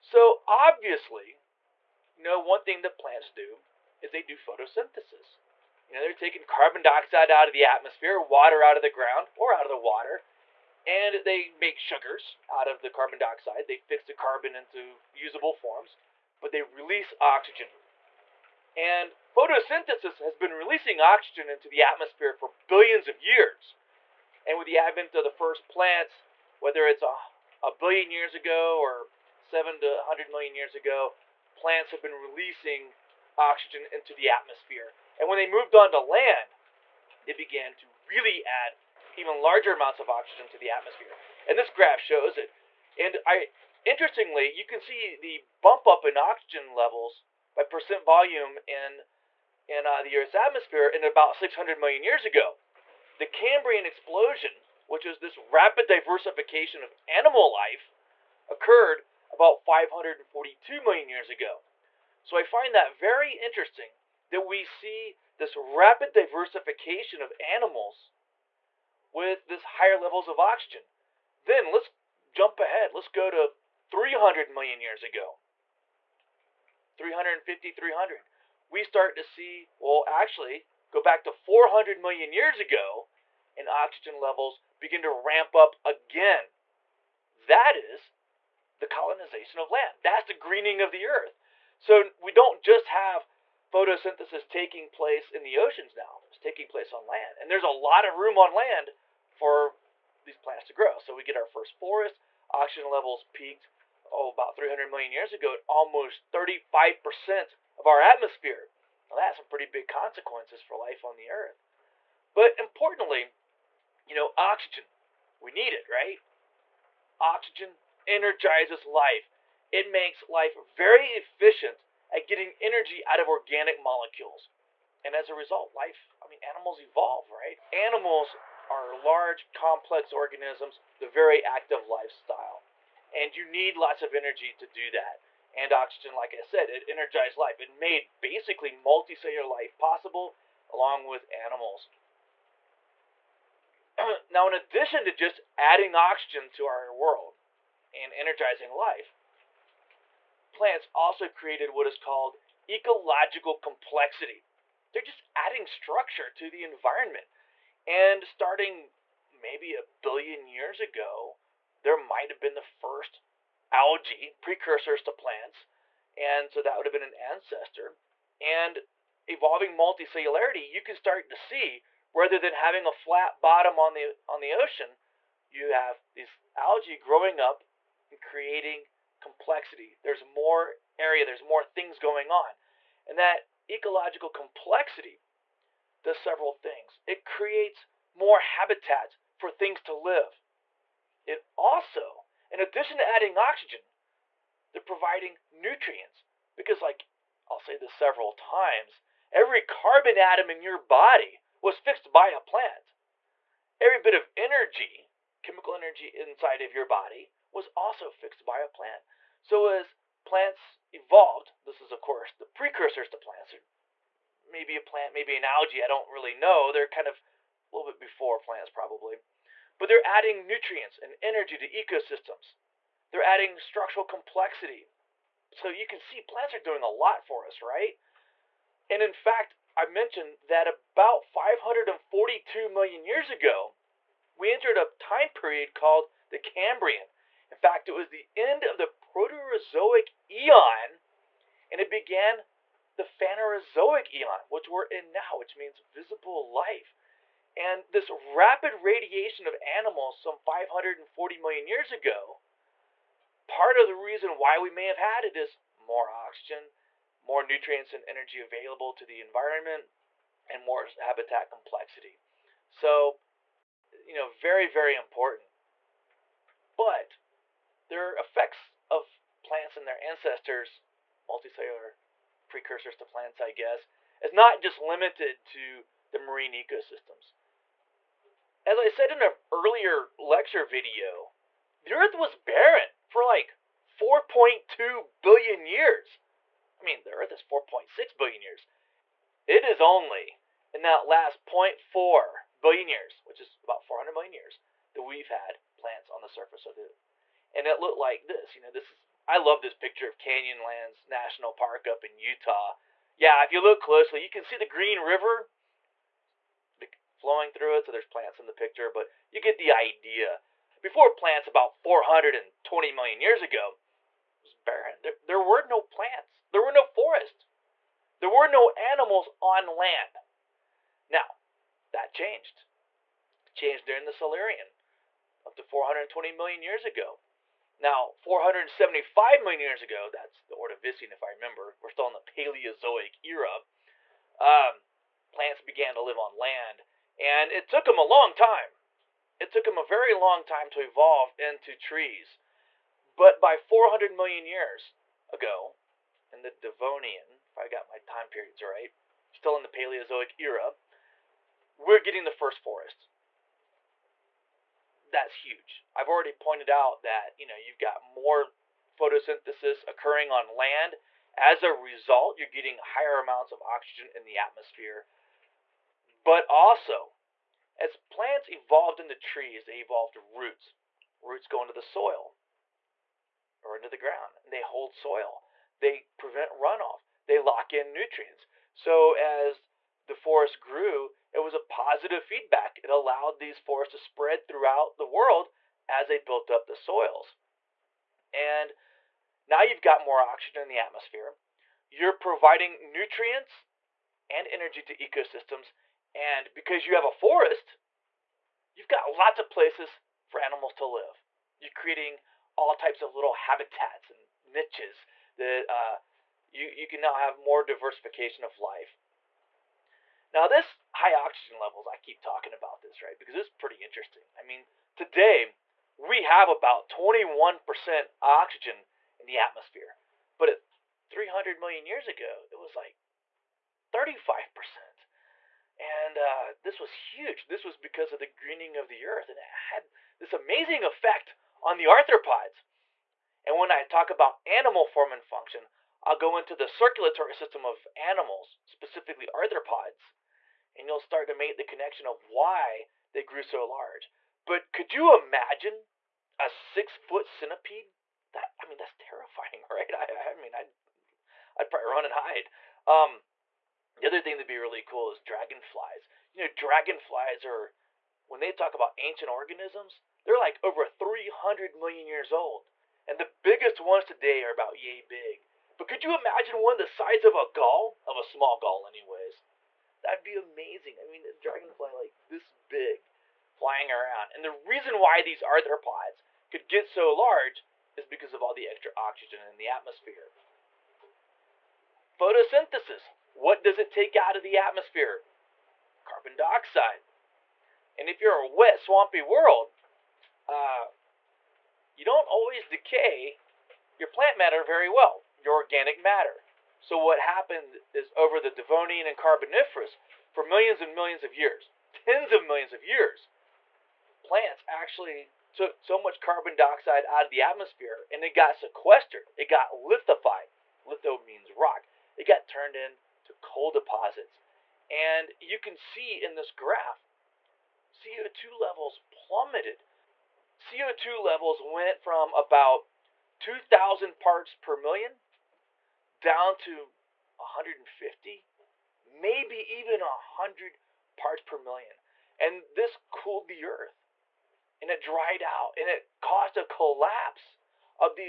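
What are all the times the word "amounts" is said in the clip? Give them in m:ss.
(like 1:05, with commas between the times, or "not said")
0:39, 6:03.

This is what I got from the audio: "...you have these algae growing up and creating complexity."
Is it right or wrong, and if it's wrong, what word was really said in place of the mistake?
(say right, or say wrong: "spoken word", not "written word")
right.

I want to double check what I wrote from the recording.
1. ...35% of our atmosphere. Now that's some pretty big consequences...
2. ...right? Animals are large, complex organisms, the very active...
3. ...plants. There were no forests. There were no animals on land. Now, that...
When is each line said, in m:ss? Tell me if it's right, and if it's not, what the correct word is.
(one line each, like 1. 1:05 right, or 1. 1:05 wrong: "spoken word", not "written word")
1. 1:46 right
2. 2:07 right
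3. 5:15 right.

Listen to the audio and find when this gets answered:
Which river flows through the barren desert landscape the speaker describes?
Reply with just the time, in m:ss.
5:04.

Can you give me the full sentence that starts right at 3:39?
But they're adding nutrients and energy to ecosystems.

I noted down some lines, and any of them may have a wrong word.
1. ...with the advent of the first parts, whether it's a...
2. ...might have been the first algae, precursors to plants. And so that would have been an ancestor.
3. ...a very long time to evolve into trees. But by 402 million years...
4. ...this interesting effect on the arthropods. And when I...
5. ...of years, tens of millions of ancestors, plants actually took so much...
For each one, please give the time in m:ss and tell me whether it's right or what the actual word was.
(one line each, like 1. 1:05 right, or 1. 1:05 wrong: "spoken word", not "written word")
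1. 0:24 wrong: "plants", not "parts"
2. 2:41 right
3. 5:39 wrong: "400", not "402"
4. 7:10 wrong: "amazing", not "interesting"
5. 8:21 wrong: "years", not "ancestors".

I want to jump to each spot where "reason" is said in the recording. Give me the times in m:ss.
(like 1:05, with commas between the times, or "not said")
4:13, 7:54.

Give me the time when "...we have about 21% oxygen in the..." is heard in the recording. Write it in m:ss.
6:55.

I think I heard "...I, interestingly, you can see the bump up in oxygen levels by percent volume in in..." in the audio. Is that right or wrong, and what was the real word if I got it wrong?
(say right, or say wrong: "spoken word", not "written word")
right.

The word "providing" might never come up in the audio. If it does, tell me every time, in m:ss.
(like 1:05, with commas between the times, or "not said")
3:14, 6:32.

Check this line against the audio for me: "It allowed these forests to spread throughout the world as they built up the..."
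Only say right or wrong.
right.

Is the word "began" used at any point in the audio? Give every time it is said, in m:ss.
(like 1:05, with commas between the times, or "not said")
0:37, 4:01, 5:35.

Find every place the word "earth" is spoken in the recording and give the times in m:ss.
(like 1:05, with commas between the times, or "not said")
0:50, 1:31, 1:51, 4:41, 4:47, 7:09, 8:53.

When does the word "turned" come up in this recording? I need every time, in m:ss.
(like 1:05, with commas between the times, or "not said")
8:32.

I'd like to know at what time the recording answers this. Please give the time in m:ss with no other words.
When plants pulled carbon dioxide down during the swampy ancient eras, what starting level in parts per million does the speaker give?
8:43.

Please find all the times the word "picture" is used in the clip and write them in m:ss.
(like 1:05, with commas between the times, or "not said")
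4:59, 5:08.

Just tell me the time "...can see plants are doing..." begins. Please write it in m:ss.
3:45.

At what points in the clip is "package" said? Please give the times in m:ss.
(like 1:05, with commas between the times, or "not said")
not said.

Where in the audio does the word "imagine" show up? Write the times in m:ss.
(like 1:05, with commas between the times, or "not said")
7:25, 7:46.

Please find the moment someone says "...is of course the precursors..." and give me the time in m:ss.
3:31.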